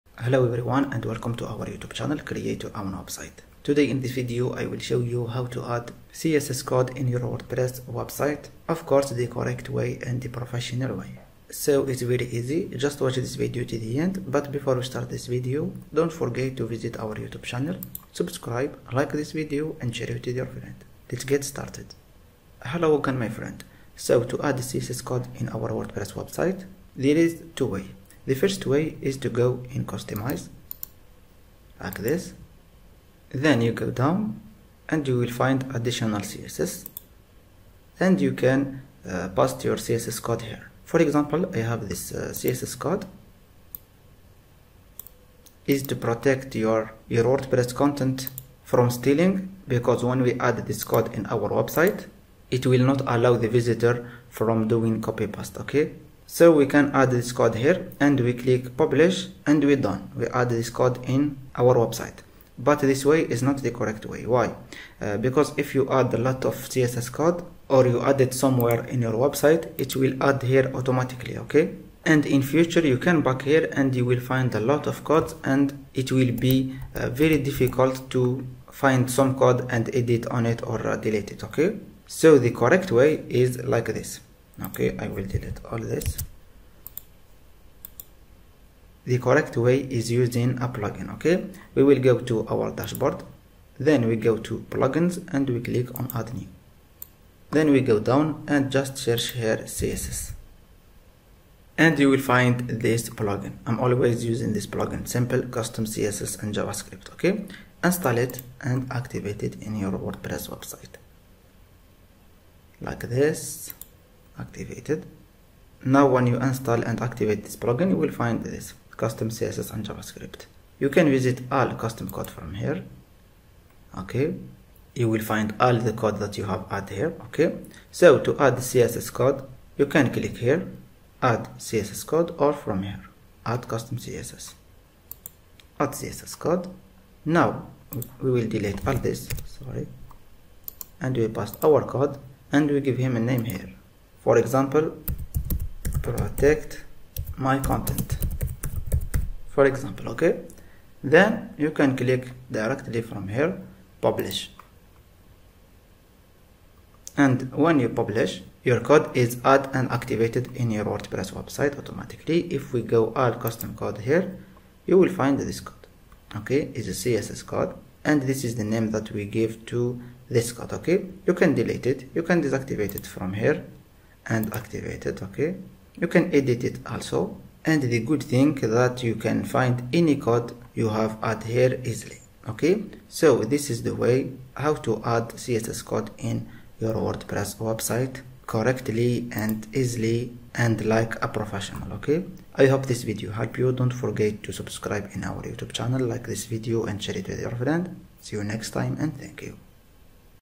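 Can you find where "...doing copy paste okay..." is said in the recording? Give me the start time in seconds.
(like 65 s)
54 s.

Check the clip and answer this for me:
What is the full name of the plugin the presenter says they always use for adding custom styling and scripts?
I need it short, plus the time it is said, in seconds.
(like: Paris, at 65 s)
Simple Custom CSS and JavaScript, at 105 s.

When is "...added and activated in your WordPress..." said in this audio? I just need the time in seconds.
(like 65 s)
159 s.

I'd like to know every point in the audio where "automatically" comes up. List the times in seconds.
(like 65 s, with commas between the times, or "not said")
70 s, 161 s.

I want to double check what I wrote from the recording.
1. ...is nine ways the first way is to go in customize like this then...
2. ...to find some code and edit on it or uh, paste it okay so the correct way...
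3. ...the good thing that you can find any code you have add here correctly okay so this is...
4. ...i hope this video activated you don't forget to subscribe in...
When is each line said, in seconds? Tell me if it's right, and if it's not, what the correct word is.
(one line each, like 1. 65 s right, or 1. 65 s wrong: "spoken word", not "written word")
1. 27 s wrong: "two", not "nine"
2. 78 s wrong: "delete", not "paste"
3. 177 s wrong: "easily", not "correctly"
4. 192 s wrong: "helped", not "activated".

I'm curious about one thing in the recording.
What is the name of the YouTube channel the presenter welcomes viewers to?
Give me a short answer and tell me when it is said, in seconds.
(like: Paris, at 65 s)
Create Your Own Website, at 2 s.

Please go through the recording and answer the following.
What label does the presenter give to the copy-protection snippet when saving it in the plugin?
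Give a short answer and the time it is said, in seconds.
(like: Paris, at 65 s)
Protect my content, at 146 s.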